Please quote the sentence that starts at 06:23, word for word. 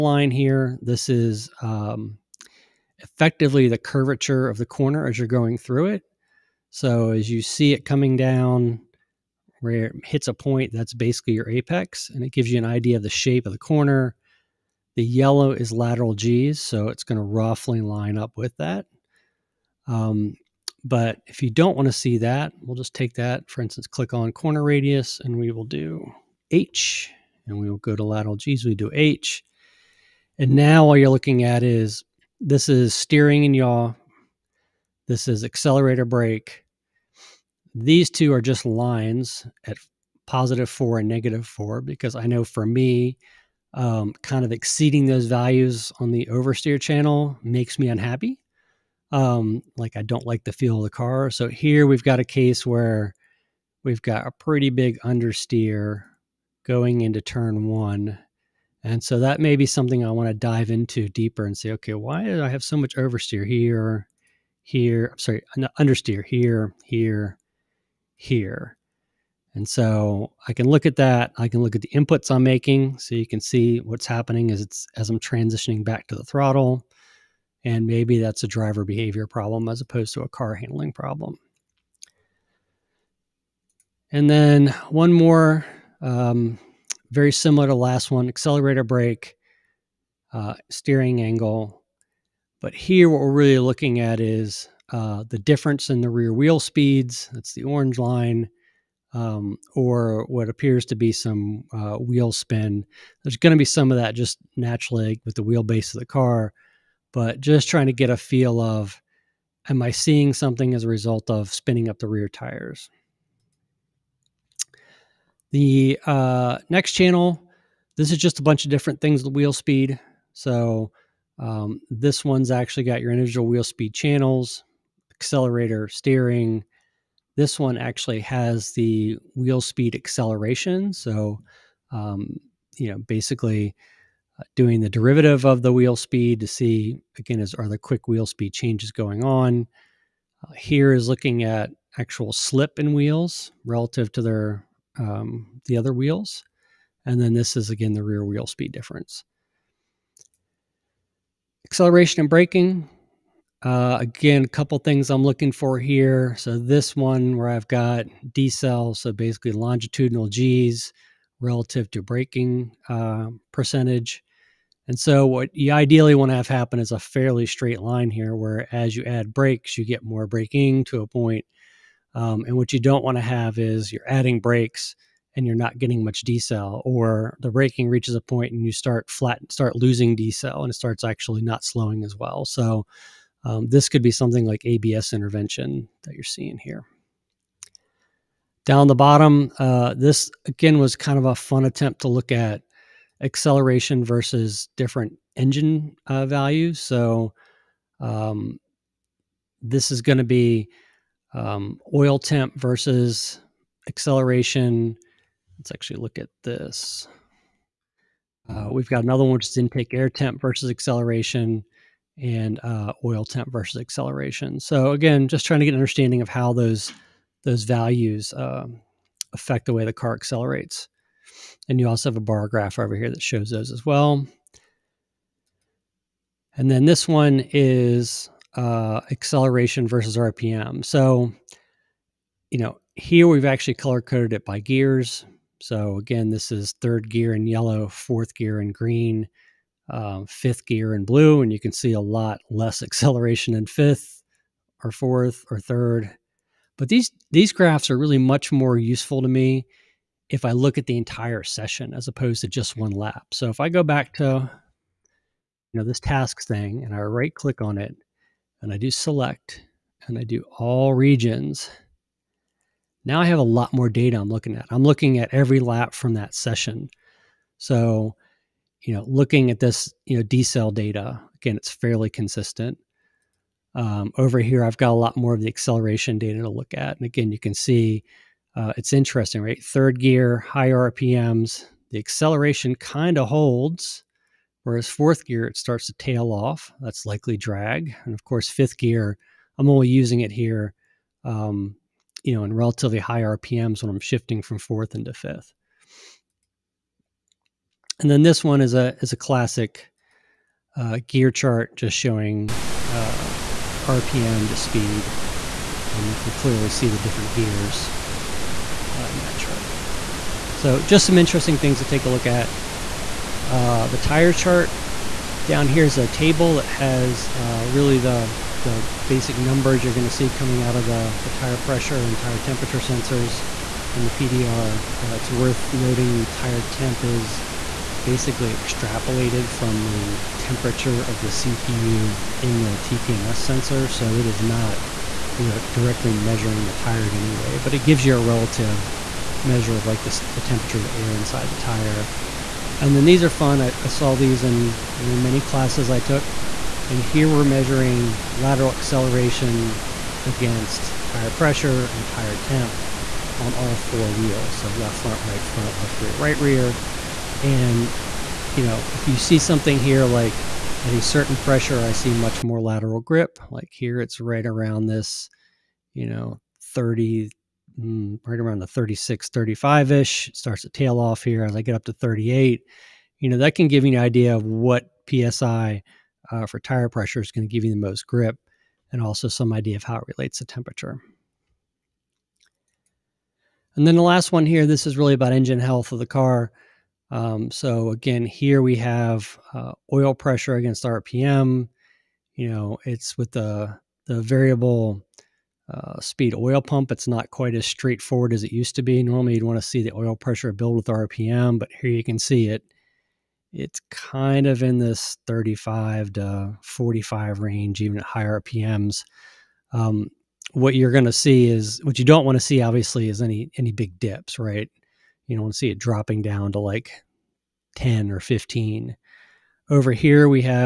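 And then the last one here, this is really about engine health of the car.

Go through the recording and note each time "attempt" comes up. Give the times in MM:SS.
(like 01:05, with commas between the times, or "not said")
03:11.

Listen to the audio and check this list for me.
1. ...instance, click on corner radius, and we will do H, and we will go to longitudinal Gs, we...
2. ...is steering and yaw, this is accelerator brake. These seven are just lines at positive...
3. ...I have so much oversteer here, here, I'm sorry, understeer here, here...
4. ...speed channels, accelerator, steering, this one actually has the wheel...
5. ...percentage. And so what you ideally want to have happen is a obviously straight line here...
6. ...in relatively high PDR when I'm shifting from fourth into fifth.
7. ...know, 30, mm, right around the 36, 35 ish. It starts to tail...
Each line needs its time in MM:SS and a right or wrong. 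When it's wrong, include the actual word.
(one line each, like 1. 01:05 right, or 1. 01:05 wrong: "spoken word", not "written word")
1. 00:23 wrong: "lateral", not "longitudinal"
2. 00:32 wrong: "two", not "seven"
3. 01:02 right
4. 02:03 right
5. 02:43 wrong: "fairly", not "obviously"
6. 04:52 wrong: "RPMs", not "PDR"
7. 06:06 right.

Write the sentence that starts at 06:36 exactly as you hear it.
It's not quite as straightforward as it used to be.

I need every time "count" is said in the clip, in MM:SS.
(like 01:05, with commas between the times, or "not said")
not said.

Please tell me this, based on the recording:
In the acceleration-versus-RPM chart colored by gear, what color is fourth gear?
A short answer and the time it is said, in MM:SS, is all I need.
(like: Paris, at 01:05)
Green, at 03:58.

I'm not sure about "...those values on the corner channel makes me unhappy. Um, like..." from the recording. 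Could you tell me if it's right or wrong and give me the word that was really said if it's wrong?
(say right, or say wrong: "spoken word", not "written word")
wrong: "oversteer", not "corner".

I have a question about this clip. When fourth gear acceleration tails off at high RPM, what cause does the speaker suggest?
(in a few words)
Drag.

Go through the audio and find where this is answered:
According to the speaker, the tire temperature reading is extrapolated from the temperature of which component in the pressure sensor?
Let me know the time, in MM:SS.
05:31.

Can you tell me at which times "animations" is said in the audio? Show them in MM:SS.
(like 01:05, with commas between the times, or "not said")
not said.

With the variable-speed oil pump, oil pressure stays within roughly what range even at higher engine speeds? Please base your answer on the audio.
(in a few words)
35 to 45.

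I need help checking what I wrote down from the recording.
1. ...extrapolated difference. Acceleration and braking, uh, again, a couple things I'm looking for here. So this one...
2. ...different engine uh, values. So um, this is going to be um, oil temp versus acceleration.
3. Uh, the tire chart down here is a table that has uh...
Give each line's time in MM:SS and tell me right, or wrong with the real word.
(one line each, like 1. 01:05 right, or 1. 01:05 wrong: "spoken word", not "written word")
1. 02:28 wrong: "speed", not "extrapolated"
2. 03:14 right
3. 05:13 right.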